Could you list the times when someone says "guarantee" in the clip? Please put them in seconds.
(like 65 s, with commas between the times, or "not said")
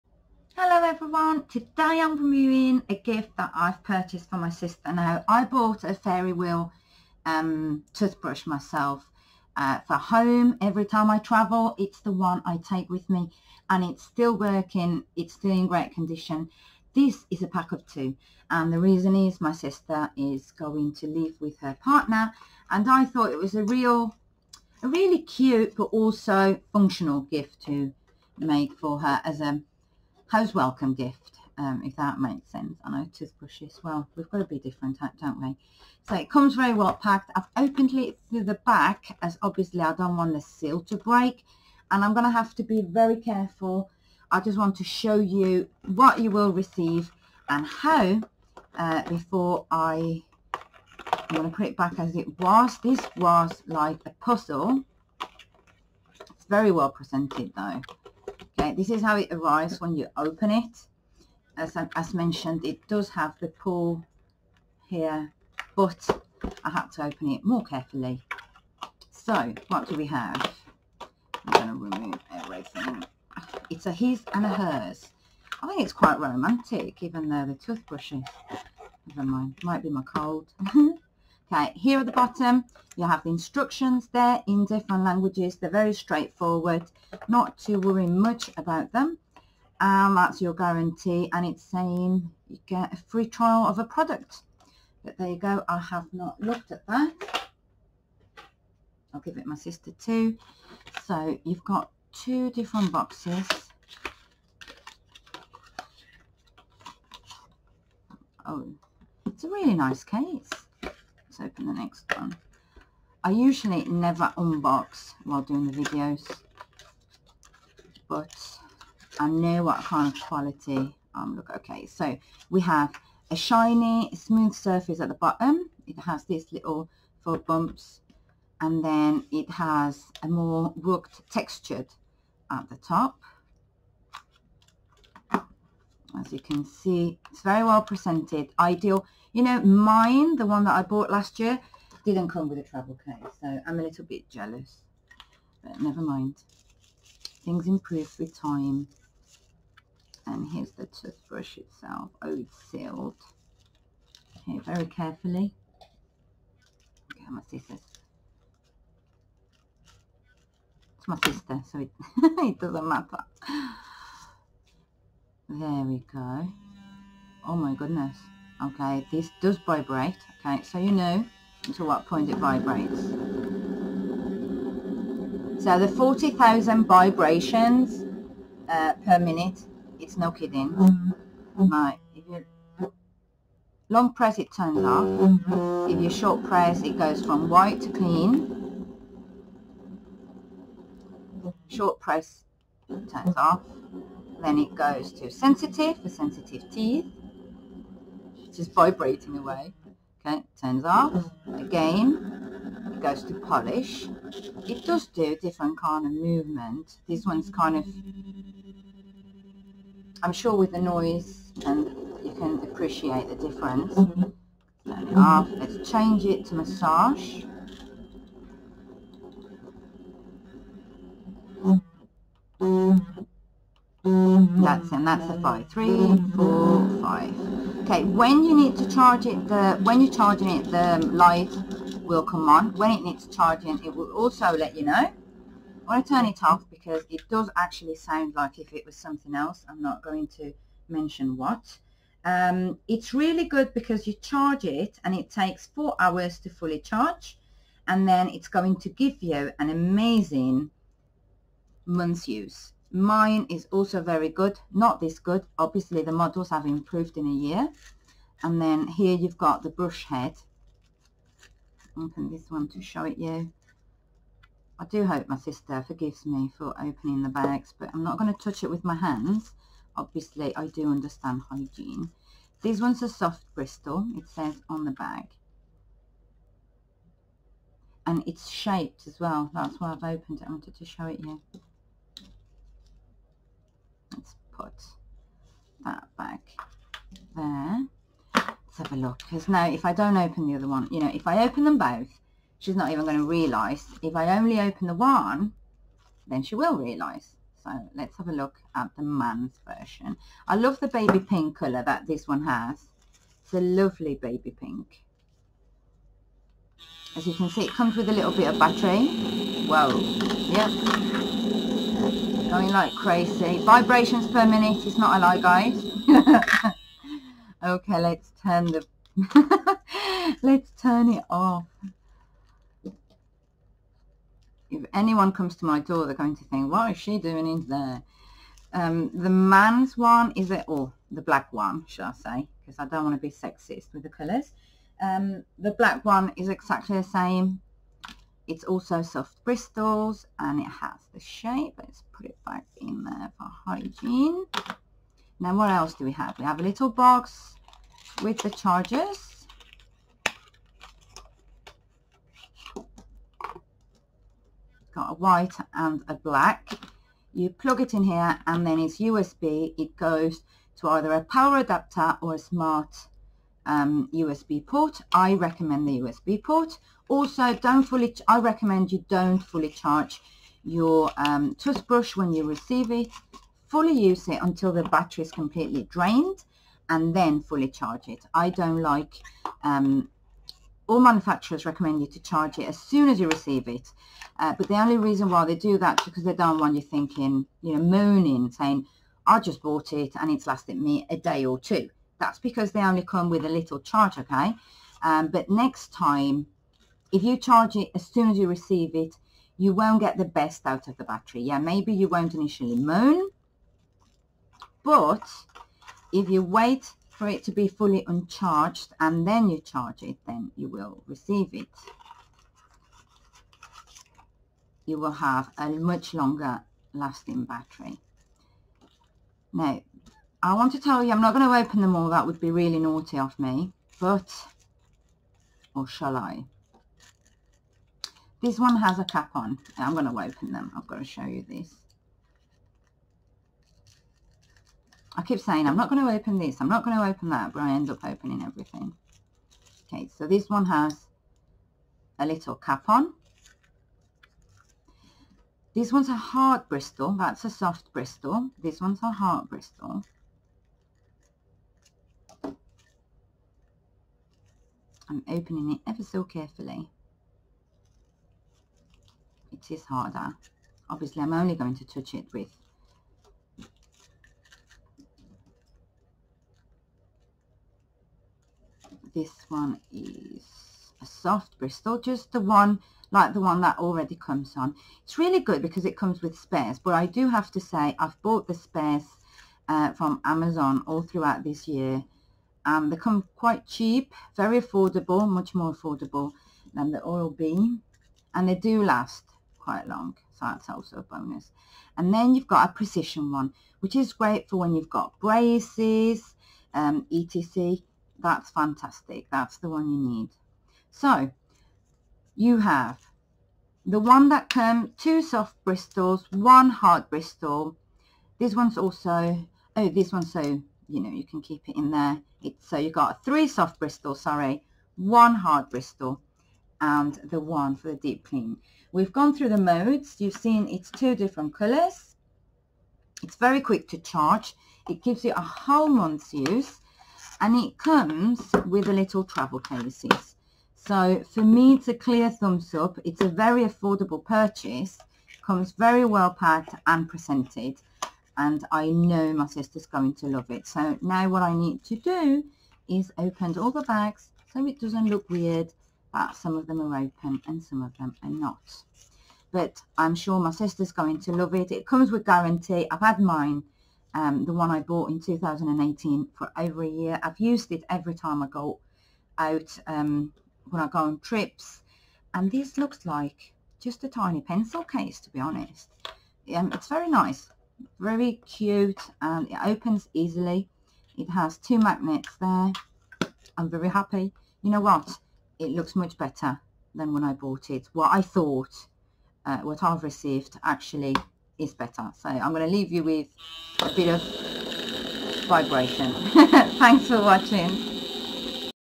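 90 s, 552 s.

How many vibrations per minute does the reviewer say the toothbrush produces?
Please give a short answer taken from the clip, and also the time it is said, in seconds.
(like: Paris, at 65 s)
40,000, at 175 s.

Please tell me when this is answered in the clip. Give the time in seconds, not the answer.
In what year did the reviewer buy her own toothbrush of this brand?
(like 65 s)
555 s.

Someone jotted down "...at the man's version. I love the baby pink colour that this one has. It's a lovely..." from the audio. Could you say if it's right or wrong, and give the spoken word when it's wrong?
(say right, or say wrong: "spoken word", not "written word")
right.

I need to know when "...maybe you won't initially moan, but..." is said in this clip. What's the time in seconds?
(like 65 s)
401 s.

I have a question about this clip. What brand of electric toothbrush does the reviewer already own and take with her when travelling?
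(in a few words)
Fairywill.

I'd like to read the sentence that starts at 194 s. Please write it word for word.
Then it goes to sensitive for sensitive teeth, just vibrating away.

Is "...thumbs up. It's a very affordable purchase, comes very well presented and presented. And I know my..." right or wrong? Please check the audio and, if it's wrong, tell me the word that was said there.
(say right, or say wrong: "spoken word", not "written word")
wrong: "packed", not "presented".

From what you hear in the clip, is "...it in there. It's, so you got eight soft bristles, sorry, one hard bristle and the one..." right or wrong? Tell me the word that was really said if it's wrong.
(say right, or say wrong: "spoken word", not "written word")
wrong: "three", not "eight".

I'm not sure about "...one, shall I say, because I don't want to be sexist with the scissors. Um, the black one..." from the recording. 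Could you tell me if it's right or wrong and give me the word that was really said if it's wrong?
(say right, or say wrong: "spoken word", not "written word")
wrong: "colours", not "scissors".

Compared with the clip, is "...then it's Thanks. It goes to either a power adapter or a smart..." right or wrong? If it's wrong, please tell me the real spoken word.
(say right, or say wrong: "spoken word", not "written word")
wrong: "USB", not "Thanks".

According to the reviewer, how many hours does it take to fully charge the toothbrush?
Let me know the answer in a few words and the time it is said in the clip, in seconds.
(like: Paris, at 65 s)
4 hours, at 245 s.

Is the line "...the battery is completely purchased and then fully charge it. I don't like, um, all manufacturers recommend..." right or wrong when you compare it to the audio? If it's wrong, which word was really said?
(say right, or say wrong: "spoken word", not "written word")
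wrong: "drained", not "purchased".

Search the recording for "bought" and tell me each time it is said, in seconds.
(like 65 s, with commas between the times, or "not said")
5 s, 140 s, 389 s, 478 s, 554 s, 577 s.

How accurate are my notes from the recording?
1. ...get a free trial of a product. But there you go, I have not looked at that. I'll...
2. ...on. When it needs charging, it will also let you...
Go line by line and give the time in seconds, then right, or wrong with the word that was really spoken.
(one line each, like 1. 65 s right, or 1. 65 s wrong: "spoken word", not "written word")
1. 92 s right
2. 232 s right.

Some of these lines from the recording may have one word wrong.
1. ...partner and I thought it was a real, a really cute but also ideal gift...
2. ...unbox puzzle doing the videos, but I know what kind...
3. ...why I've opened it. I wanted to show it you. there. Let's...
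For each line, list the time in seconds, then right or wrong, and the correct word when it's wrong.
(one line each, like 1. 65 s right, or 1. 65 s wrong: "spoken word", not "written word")
1. 21 s wrong: "functional", not "ideal"
2. 114 s wrong: "while", not "puzzle"
3. 279 s right.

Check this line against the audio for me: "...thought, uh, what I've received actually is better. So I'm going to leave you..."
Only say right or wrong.
right.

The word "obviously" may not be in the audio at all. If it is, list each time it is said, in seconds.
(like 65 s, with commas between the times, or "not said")
39 s, 255 s, 269 s, 460 s.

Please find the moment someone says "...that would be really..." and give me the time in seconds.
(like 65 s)
422 s.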